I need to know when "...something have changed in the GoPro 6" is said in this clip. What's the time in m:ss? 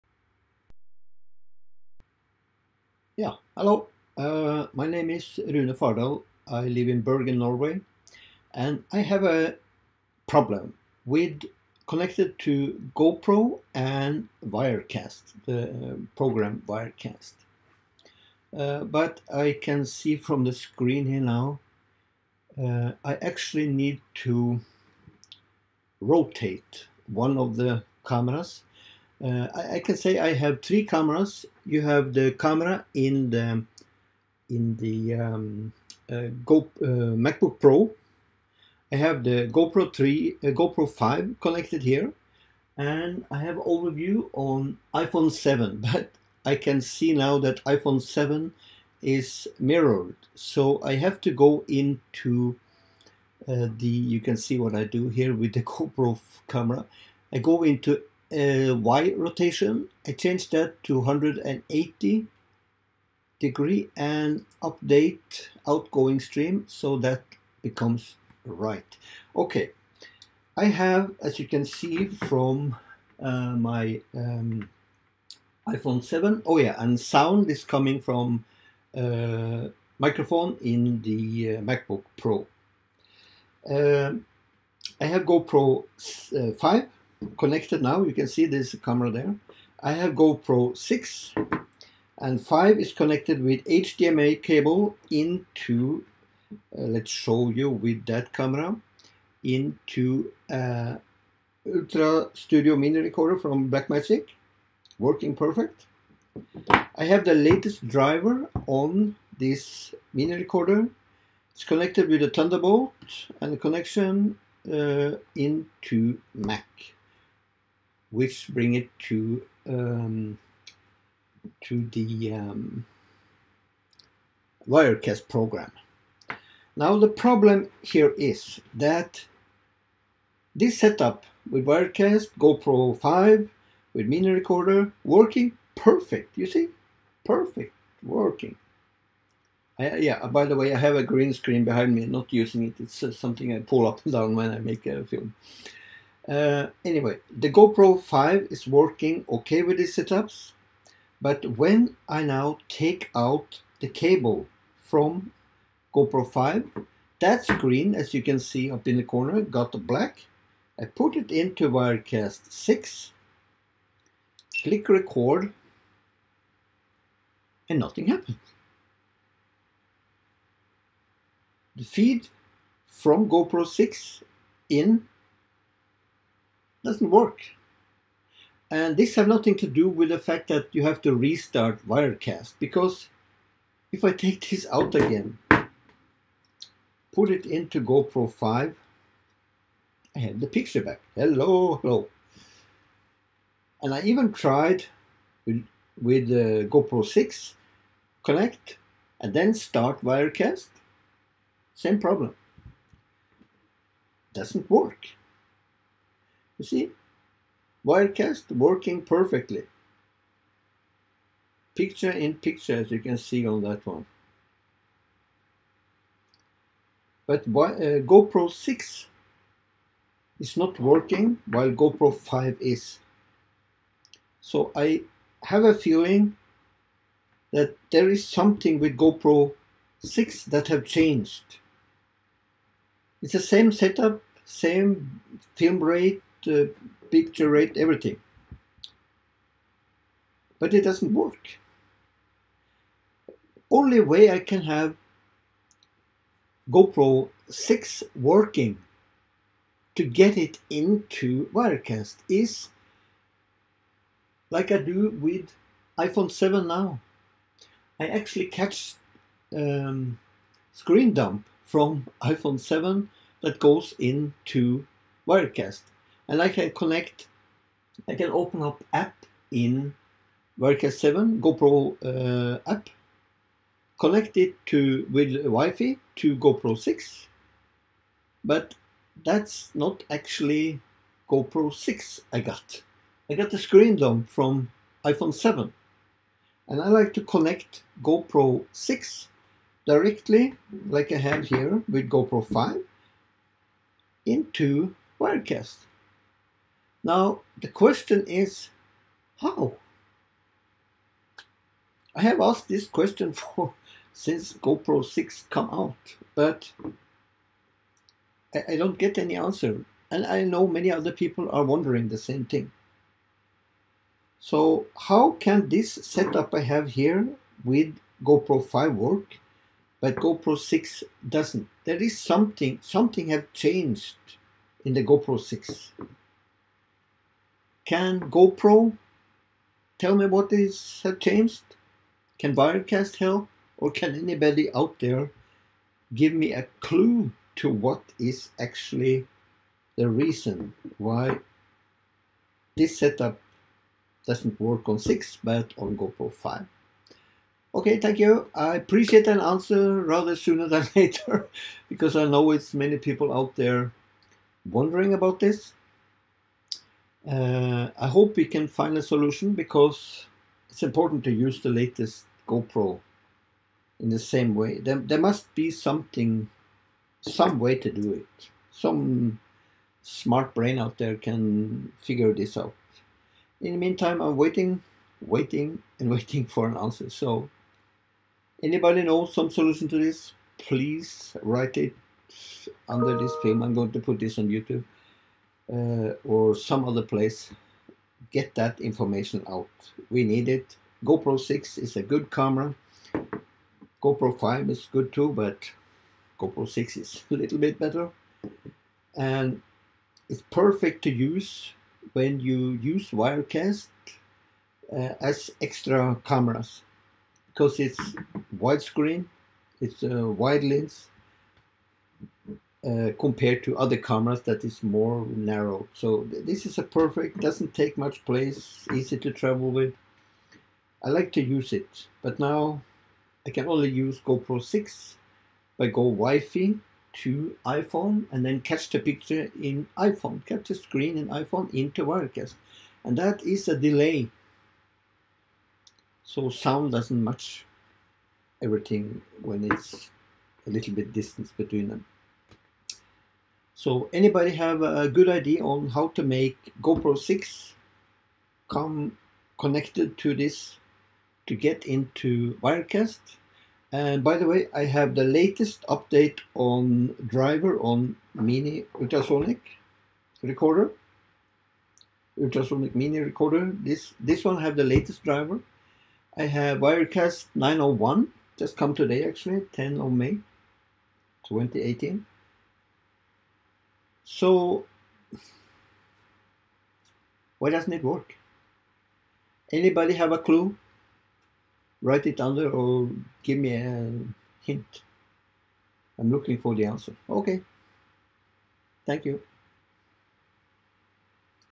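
5:22.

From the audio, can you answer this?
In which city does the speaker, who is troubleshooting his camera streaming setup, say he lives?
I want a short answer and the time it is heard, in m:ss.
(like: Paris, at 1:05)
Bergen, at 0:07.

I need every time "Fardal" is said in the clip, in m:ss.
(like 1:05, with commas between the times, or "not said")
0:05.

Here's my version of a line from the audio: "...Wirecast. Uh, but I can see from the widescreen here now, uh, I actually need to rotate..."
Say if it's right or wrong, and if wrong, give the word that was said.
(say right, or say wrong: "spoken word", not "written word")
wrong: "screen", not "widescreen".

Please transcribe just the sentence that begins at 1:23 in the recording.
Uh, I have GoPro uh, 5 connected now.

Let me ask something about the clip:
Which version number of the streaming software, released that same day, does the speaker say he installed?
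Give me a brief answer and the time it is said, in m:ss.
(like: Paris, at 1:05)
901, at 7:47.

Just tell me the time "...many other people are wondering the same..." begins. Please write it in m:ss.
5:10.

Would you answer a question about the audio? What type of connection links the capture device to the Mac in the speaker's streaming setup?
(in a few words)
Thunderbolt.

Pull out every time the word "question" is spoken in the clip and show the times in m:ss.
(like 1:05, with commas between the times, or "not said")
4:57, 5:02.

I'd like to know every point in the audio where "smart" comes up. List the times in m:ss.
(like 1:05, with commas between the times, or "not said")
6:10.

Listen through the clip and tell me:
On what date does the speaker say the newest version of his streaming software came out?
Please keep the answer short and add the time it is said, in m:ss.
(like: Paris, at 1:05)
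10 May 2018, at 7:49.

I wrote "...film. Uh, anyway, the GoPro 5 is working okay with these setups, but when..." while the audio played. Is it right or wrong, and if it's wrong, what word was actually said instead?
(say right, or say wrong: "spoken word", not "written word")
right.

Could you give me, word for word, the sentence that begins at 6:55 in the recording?
So th this is a perfect, doesn't take much place, easy to travel with.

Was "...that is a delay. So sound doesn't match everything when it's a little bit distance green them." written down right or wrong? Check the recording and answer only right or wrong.
wrong.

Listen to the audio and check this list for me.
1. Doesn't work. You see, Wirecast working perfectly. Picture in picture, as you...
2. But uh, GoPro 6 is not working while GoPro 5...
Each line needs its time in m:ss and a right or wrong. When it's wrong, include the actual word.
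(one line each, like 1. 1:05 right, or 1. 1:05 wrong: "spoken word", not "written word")
1. 3:24 right
2. 3:37 right.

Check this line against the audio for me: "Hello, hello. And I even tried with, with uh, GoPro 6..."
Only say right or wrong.
right.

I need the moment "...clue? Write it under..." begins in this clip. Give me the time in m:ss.
8:00.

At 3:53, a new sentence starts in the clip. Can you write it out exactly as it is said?
It's the same setup, same film rate, uh, picture rate everything.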